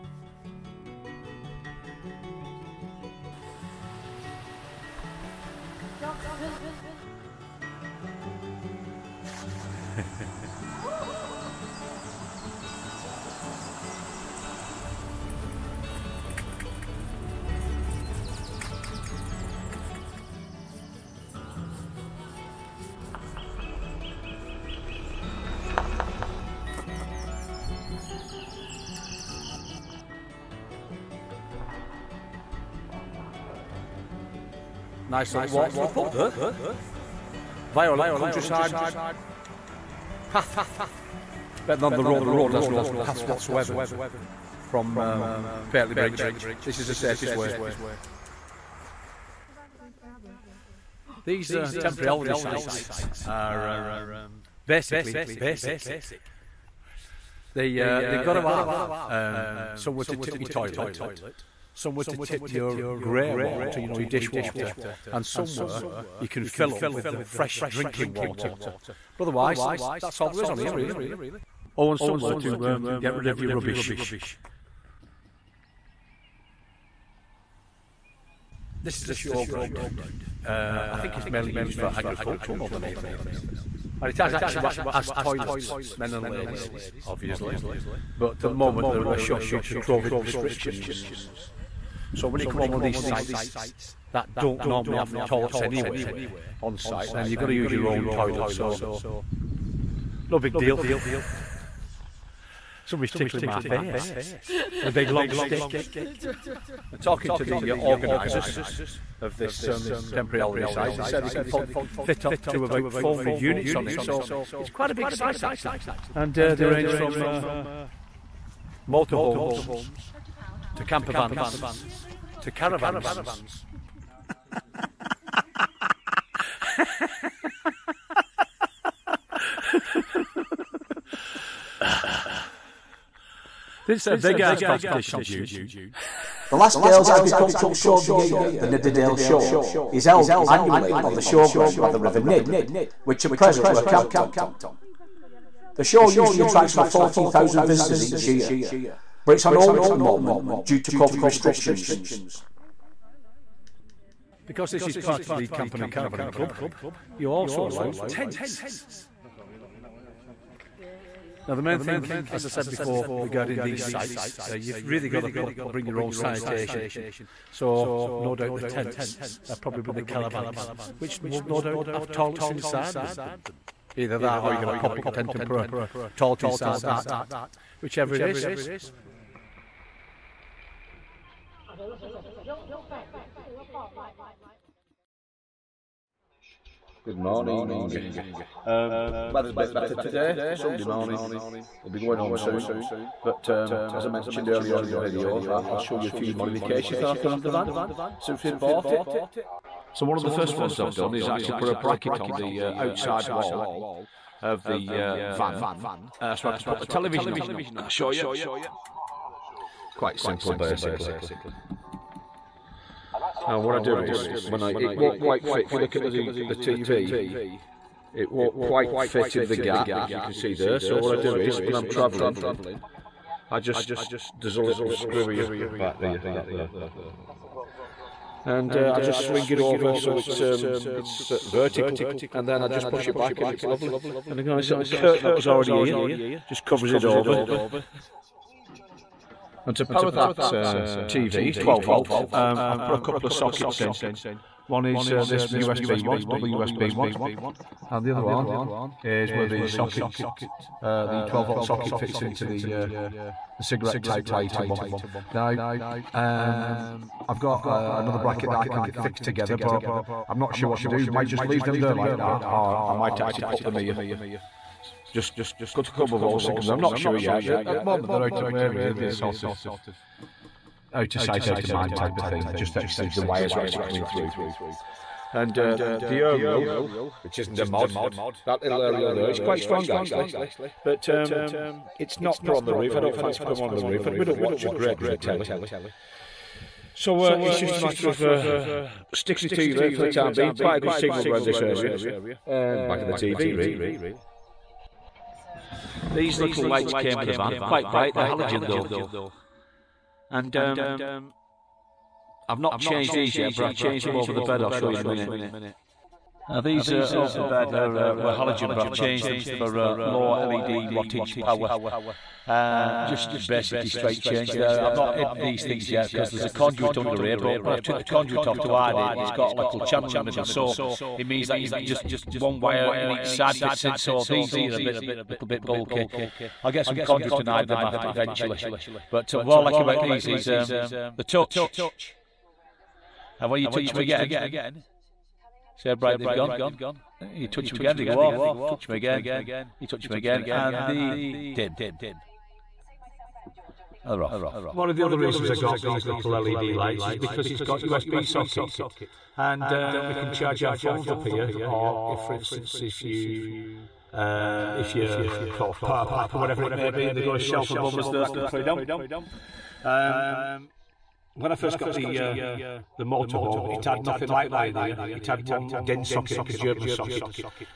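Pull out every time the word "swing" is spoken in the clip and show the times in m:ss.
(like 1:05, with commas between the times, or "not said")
3:49.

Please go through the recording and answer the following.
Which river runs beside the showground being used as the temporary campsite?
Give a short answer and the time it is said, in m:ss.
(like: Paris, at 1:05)
River Nid, at 2:21.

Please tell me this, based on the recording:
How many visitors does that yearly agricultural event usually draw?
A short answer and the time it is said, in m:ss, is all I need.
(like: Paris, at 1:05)
Over 14,000, at 2:26.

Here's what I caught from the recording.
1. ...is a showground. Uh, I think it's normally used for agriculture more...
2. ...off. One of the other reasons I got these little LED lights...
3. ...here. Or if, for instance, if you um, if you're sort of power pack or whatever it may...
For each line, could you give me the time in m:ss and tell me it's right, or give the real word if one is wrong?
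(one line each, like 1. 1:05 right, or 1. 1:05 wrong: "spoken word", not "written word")
1. 1:19 wrong: "mainly", not "normally"
2. 5:44 right
3. 5:51 right.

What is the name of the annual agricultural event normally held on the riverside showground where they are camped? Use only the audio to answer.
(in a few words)
Nidderdale Show.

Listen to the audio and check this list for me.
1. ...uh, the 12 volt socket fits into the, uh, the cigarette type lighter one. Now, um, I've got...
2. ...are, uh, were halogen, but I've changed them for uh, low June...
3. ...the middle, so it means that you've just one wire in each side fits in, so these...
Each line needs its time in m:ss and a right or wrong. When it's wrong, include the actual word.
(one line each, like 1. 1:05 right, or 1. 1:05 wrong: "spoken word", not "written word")
1. 4:10 right
2. 5:07 wrong: "LED", not "June"
3. 5:20 right.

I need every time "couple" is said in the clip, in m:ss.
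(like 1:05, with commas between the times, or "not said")
4:03, 4:25.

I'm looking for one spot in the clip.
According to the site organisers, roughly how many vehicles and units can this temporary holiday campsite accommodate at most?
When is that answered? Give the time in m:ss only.
1:52.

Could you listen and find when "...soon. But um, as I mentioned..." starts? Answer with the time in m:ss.
3:12.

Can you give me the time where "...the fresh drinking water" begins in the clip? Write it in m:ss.
1:07.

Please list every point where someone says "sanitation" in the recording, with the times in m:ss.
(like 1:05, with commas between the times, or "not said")
2:46.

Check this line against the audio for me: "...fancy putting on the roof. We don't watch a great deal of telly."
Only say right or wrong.
right.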